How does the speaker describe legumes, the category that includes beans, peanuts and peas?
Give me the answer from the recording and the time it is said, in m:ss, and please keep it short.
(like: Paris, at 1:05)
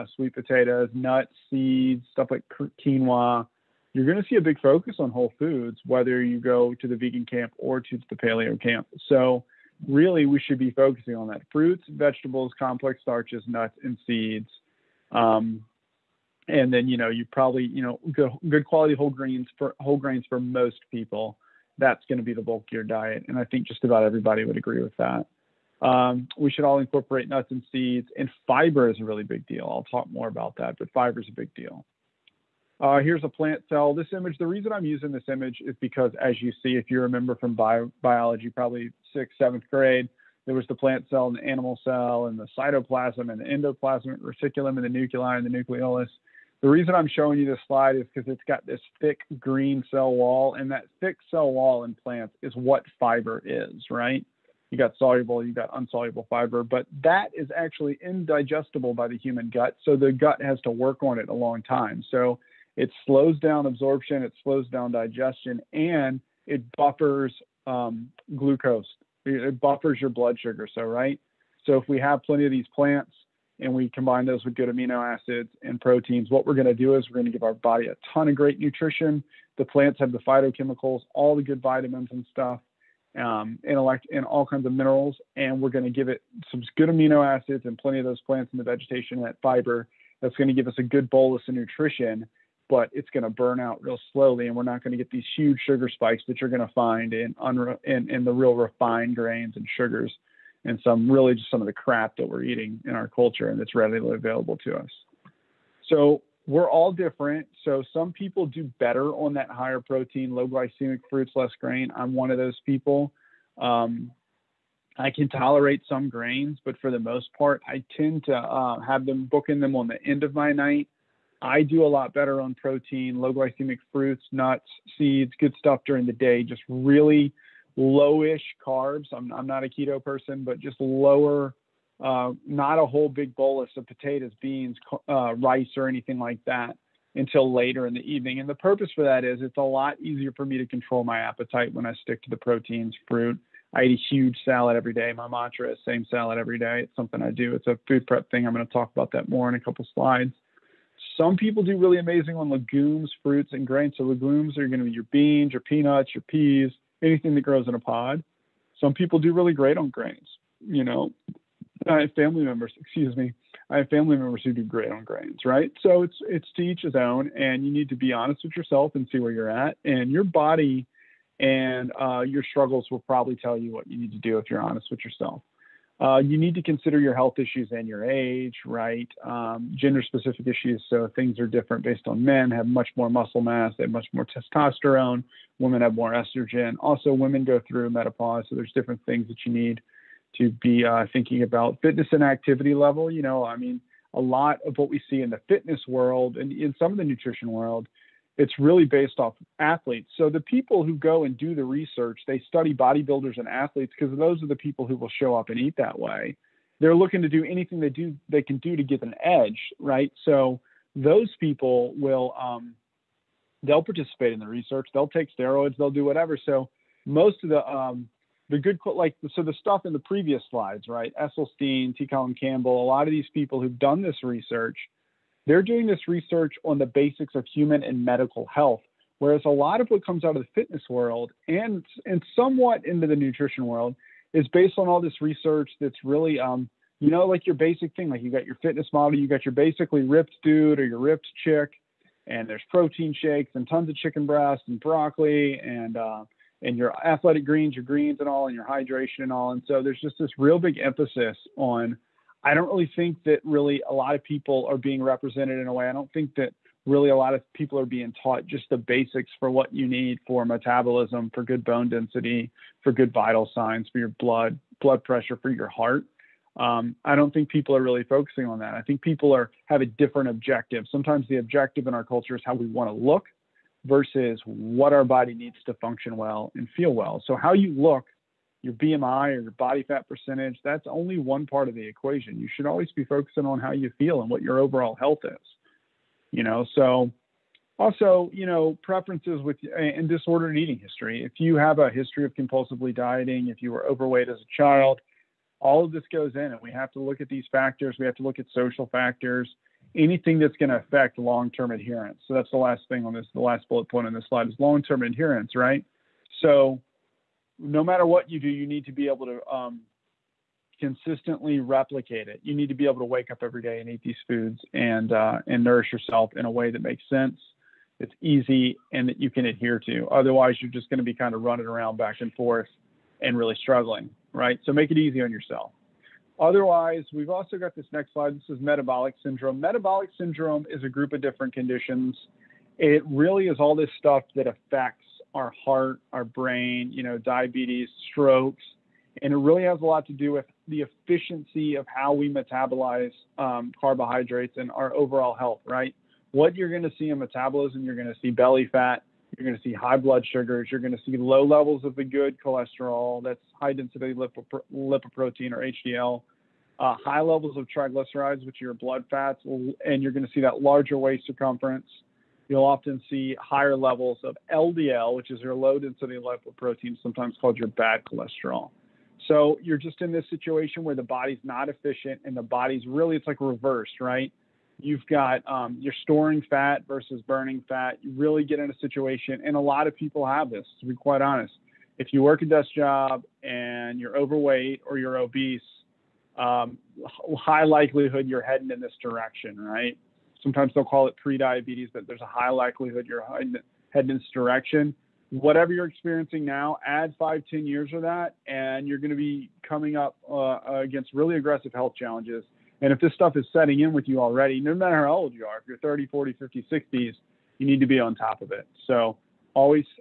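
anything that grows in a pod, at 2:37.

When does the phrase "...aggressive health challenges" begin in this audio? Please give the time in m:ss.
6:41.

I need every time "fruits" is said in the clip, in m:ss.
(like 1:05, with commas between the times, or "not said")
0:11, 1:51, 2:03, 2:23, 2:33.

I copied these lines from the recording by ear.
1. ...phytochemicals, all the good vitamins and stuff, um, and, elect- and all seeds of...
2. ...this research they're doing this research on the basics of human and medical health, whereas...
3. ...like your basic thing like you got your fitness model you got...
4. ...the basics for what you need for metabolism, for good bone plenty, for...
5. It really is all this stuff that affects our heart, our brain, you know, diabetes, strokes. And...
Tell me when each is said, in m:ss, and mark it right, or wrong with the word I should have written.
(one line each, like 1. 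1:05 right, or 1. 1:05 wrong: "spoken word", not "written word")
1. 1:20 wrong: "kinds", not "seeds"
2. 3:44 right
3. 3:57 right
4. 4:18 wrong: "density", not "plenty"
5. 5:32 right.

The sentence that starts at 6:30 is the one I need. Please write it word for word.
sometimes they'll call it pre-diabetes, but there's a high likelihood you're heading in this direction.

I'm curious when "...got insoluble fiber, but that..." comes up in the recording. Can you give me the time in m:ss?
0:55.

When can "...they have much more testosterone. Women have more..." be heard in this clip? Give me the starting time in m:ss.
3:03.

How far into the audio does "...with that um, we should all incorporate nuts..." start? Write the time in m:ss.
0:24.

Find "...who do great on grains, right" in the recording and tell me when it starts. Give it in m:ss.
2:44.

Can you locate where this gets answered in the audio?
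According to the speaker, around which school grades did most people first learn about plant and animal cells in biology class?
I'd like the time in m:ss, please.
0:39.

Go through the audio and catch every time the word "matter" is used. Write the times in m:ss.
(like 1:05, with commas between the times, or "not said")
5:07, 6:44.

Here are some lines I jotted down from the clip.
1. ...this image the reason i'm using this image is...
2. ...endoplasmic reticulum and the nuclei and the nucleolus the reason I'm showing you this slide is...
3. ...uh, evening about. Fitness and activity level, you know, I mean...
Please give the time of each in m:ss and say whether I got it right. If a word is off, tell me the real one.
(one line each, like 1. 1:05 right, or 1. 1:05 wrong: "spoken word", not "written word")
1. 0:33 right
2. 0:43 right
3. 3:10 wrong: "thinking", not "evening".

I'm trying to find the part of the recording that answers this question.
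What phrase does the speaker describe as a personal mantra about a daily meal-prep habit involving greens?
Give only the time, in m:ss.
2:25.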